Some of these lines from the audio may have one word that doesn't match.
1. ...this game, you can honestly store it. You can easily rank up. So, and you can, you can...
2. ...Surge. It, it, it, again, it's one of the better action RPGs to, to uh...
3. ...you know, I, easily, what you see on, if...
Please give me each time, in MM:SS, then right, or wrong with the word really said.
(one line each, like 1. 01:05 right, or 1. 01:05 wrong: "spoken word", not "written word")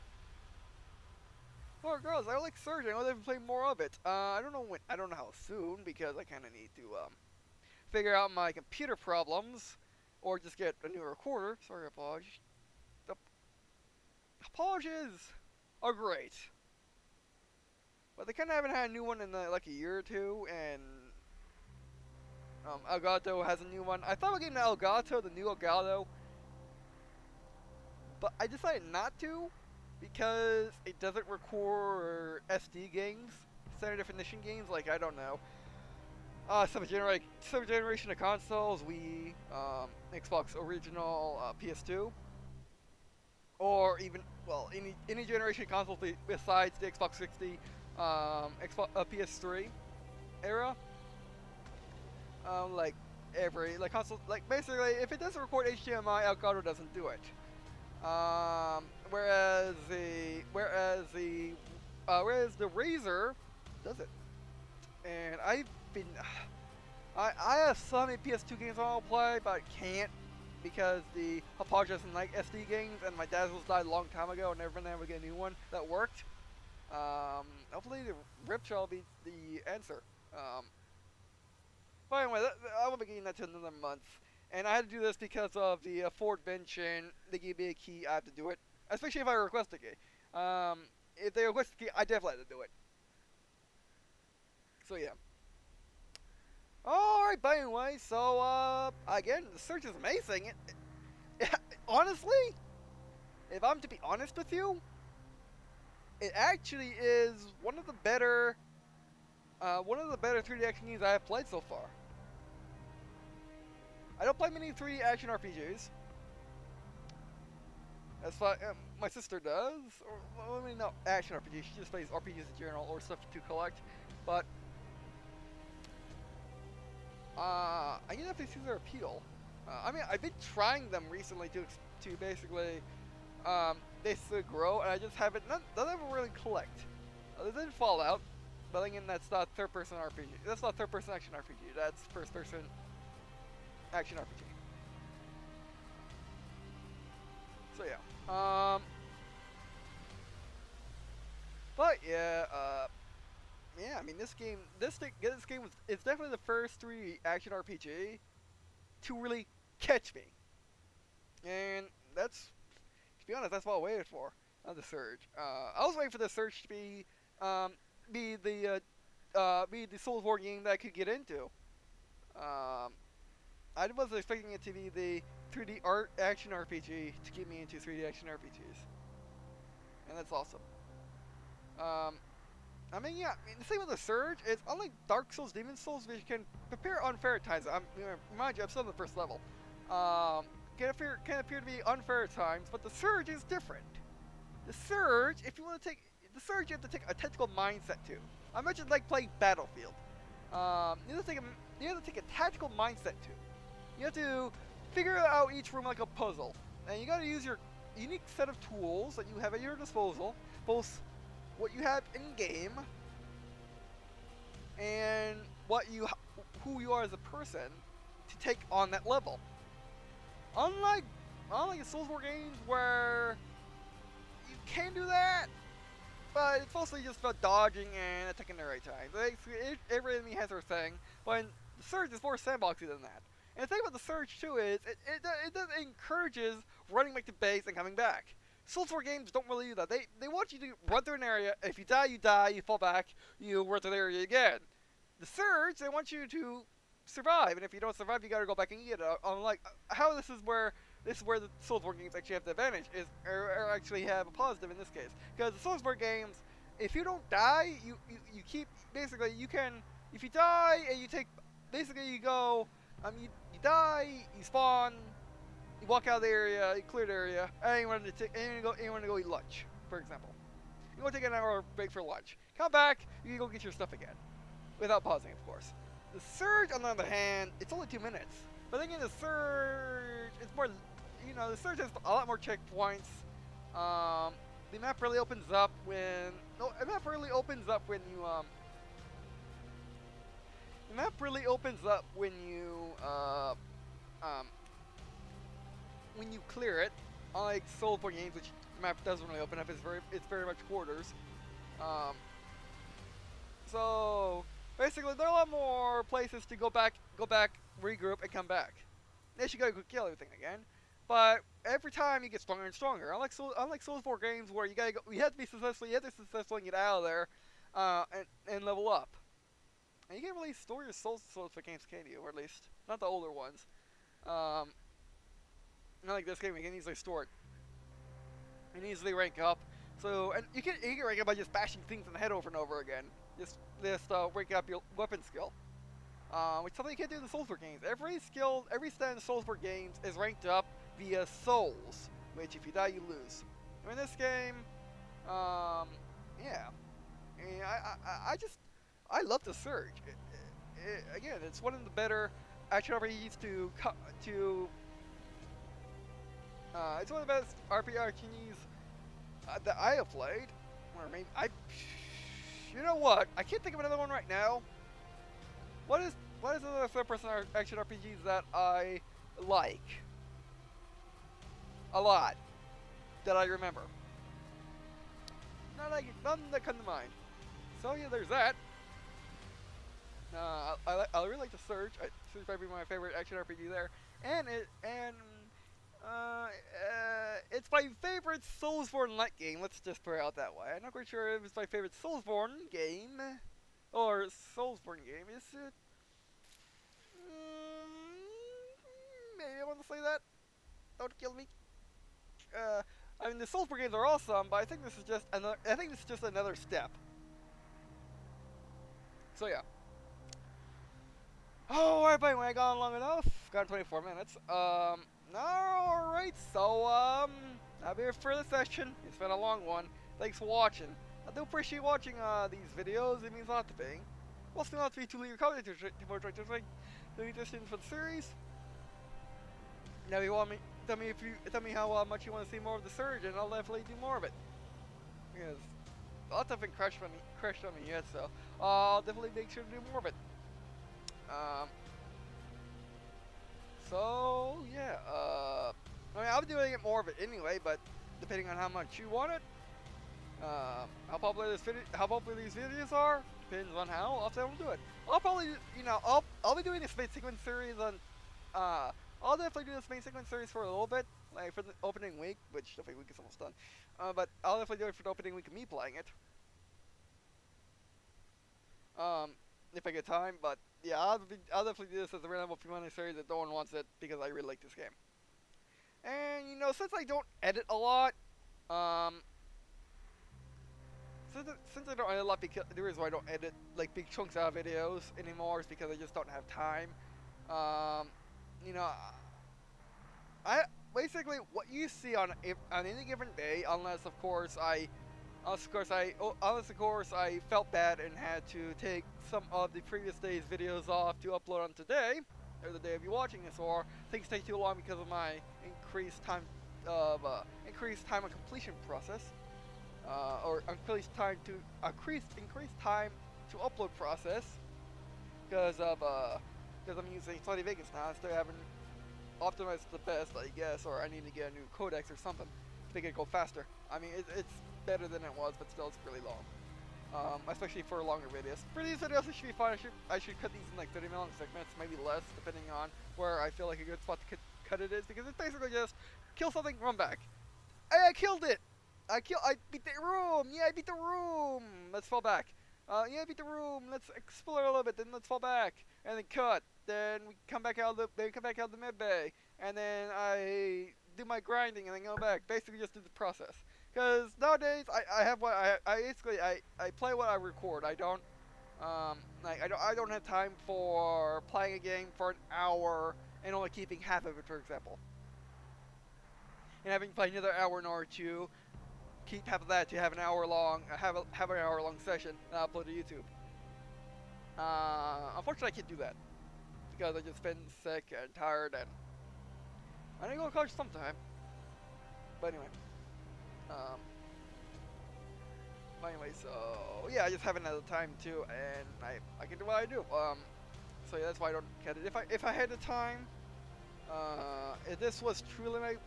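1. 05:26 wrong: "easily", not "honestly"
2. 05:49 right
3. 08:08 wrong: "basically", not "easily".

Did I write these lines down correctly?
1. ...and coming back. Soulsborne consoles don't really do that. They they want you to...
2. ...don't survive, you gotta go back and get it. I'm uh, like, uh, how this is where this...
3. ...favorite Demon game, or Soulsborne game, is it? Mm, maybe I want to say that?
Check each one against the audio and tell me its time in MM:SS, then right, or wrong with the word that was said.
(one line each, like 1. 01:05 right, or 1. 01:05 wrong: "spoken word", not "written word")
1. 03:57 wrong: "games", not "consoles"
2. 04:07 right
3. 06:31 wrong: "Soulsborne", not "Demon".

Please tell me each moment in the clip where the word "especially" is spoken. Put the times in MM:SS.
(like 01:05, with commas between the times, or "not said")
01:28, 08:47.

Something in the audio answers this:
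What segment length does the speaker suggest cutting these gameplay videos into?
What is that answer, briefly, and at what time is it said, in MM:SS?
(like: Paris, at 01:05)
30 minutes, at 08:50.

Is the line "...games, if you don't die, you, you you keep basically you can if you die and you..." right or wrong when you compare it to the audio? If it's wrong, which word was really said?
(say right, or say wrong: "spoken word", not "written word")
right.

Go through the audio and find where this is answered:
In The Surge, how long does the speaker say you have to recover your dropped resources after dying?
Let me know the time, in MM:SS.
04:37.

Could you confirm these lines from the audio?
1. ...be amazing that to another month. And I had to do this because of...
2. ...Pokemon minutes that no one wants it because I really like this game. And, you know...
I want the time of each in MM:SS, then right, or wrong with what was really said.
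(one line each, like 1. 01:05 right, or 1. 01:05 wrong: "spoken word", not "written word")
1. 01:22 wrong: "getting", not "amazing"
2. 07:52 wrong: "series", not "minutes".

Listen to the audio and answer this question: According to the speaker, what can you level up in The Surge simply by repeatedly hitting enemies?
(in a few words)
weapon skill.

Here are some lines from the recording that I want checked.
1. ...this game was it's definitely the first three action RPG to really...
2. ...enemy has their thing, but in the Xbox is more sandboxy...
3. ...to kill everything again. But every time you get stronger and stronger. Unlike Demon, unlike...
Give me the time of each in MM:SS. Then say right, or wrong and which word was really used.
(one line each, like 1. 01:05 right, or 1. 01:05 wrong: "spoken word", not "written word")
1. 02:34 right
2. 03:50 wrong: "Surge", not "Xbox"
3. 05:09 wrong: "Soul", not "Demon".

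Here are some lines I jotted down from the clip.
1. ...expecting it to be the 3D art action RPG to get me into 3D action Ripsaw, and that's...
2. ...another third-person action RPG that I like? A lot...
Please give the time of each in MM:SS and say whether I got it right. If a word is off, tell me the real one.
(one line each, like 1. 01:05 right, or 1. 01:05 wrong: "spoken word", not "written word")
1. 02:54 wrong: "RPGs", not "Ripsaw"
2. 06:06 right.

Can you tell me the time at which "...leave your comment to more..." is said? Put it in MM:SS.
07:05.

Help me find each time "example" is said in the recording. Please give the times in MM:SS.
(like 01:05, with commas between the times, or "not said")
04:29, 09:24.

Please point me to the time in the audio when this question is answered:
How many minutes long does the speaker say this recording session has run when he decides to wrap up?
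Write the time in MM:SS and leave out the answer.
06:53.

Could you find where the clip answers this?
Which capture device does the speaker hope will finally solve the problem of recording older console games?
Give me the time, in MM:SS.
01:18.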